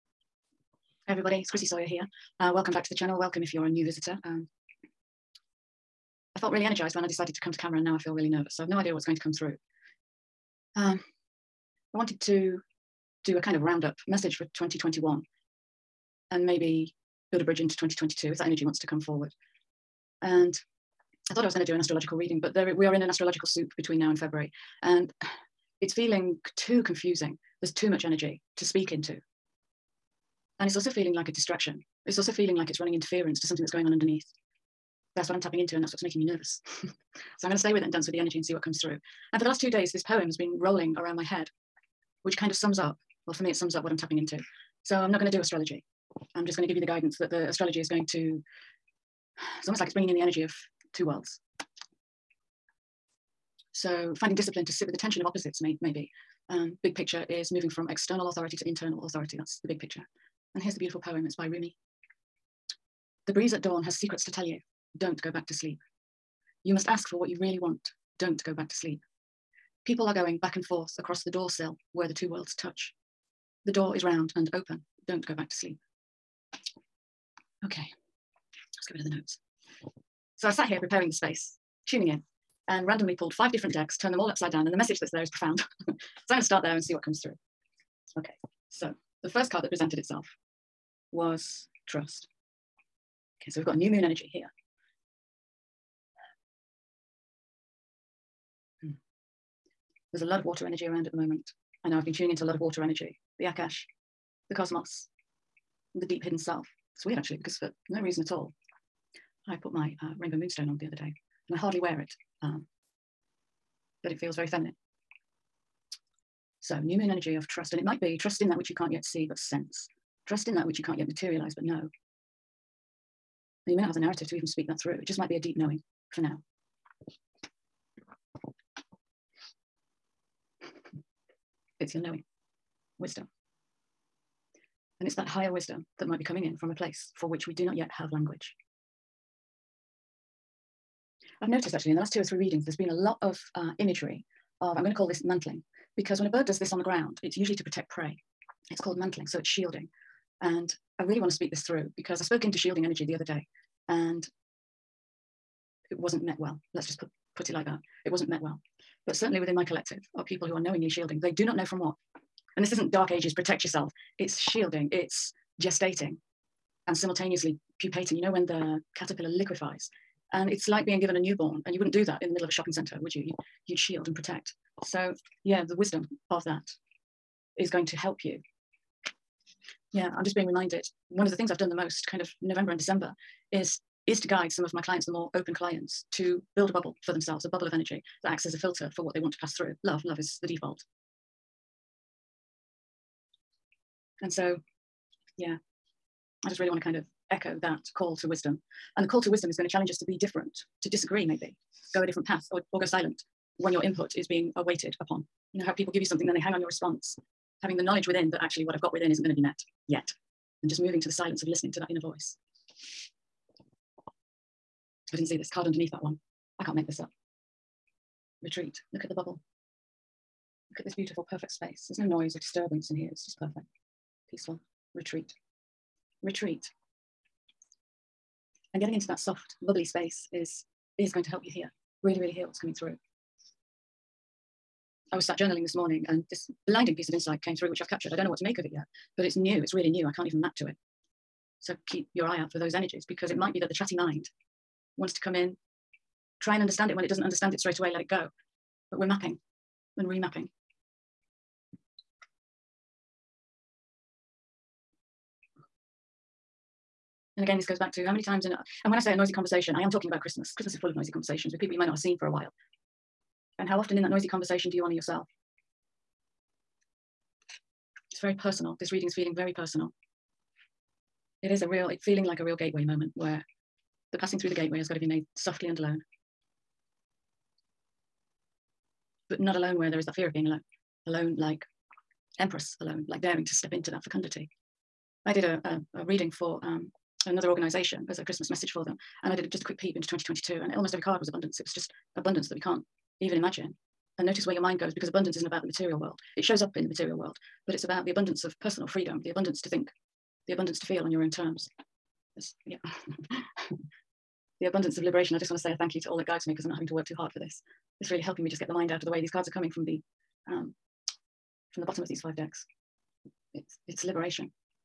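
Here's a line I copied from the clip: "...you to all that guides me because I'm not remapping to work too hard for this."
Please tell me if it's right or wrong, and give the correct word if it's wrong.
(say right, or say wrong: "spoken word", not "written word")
wrong: "having", not "remapping".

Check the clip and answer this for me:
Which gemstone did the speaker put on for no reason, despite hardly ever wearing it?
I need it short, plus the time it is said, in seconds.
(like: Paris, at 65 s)
rainbow moonstone, at 110 s.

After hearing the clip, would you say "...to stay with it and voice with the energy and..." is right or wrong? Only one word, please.
wrong.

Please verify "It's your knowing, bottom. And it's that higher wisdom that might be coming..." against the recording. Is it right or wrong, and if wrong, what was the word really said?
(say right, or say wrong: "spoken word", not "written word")
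wrong: "wisdom", not "bottom".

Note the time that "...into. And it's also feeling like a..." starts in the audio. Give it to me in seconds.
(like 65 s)
28 s.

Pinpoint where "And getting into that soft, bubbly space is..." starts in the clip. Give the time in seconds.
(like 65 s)
228 s.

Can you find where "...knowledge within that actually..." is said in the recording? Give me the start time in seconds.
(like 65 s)
207 s.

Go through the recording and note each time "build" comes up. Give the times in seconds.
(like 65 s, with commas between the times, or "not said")
17 s, 186 s.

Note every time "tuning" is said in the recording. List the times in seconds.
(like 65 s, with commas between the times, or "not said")
81 s, 102 s.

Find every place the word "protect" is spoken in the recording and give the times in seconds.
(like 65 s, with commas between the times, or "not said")
147 s, 163 s, 174 s.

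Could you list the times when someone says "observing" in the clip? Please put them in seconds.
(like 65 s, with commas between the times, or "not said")
not said.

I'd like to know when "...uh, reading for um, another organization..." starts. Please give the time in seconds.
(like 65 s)
285 s.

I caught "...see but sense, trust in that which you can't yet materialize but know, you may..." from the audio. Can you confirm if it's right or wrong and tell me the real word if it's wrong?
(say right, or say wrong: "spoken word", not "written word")
right.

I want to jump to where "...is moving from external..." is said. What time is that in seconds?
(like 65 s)
57 s.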